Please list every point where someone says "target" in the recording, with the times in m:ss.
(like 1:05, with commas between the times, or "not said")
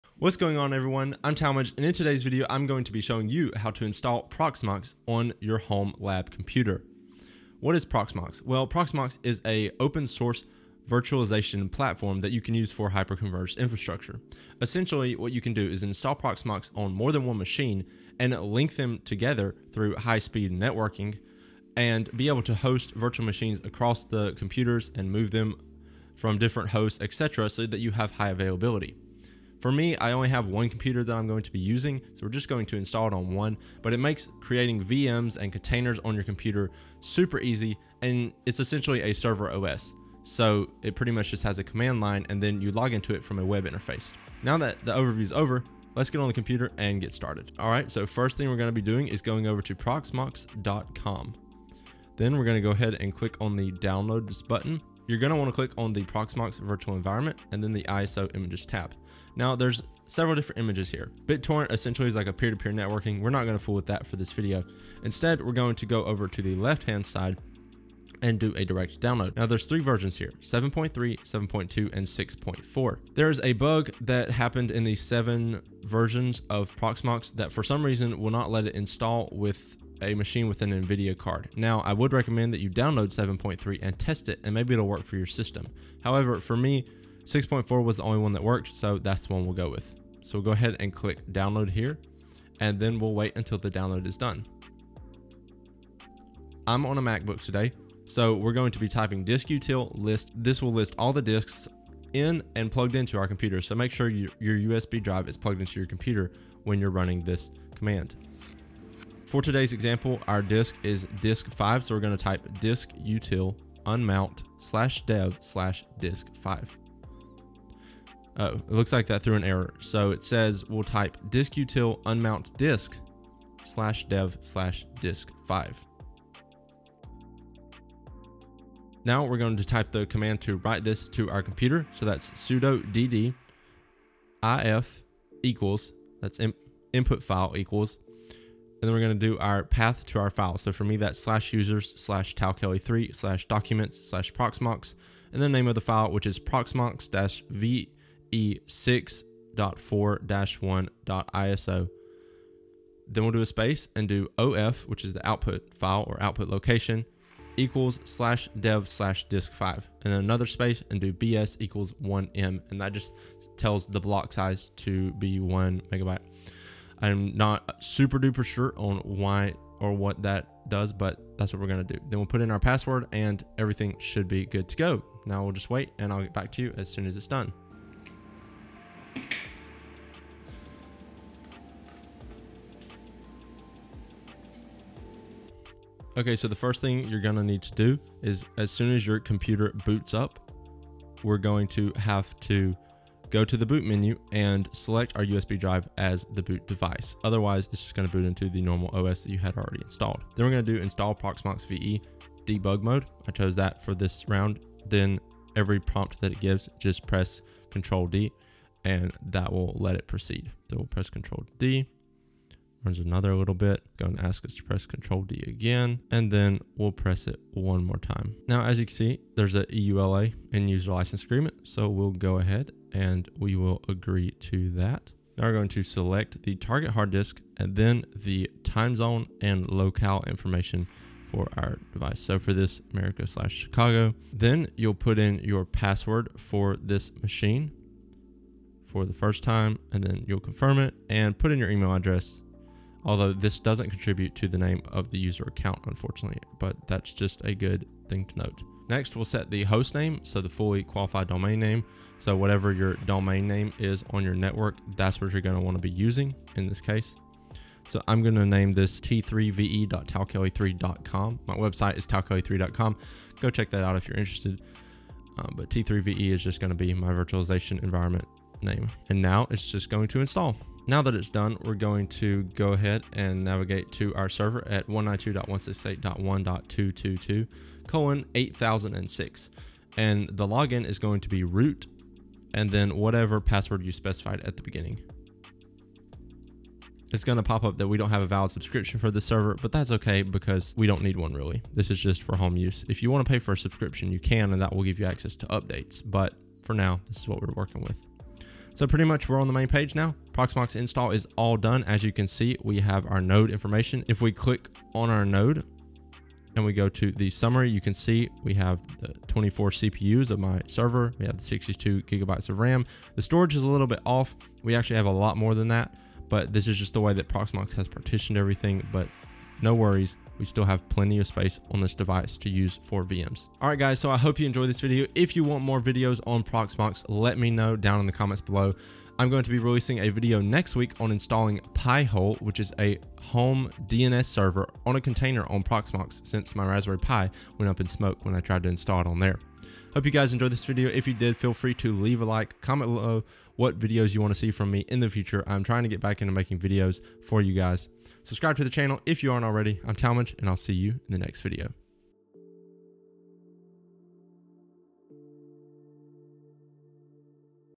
3:46.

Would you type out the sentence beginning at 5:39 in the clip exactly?
Hope you guys enjoyed this video.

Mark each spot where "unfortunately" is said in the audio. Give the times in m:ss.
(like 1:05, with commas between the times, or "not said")
4:05.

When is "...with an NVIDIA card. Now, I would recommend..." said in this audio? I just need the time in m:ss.
1:20.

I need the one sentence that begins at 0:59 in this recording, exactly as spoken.
Now there's several different images here.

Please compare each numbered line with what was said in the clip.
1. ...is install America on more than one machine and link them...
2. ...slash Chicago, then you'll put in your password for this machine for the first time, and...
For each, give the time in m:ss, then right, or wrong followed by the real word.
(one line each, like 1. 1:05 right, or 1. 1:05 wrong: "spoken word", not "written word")
1. 0:15 wrong: "Proxmox", not "America"
2. 3:53 right.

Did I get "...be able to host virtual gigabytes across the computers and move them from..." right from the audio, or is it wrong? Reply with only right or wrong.
wrong.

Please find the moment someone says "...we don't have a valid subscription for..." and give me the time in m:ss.
4:47.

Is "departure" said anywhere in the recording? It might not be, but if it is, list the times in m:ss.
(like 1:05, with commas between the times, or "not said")
not said.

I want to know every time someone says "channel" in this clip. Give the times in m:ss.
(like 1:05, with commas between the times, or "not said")
5:48.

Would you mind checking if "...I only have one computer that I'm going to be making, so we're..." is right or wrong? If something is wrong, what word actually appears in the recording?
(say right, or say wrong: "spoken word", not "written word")
wrong: "using", not "making".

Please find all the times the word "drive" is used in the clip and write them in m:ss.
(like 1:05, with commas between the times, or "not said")
1:45, 3:15.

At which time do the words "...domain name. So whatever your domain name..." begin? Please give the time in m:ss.
4:11.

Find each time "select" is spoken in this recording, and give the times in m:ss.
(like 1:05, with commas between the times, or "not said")
3:14, 3:45.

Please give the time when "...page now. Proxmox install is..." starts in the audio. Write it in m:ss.
4:59.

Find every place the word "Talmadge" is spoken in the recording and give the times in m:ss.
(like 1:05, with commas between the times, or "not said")
0:01, 5:49.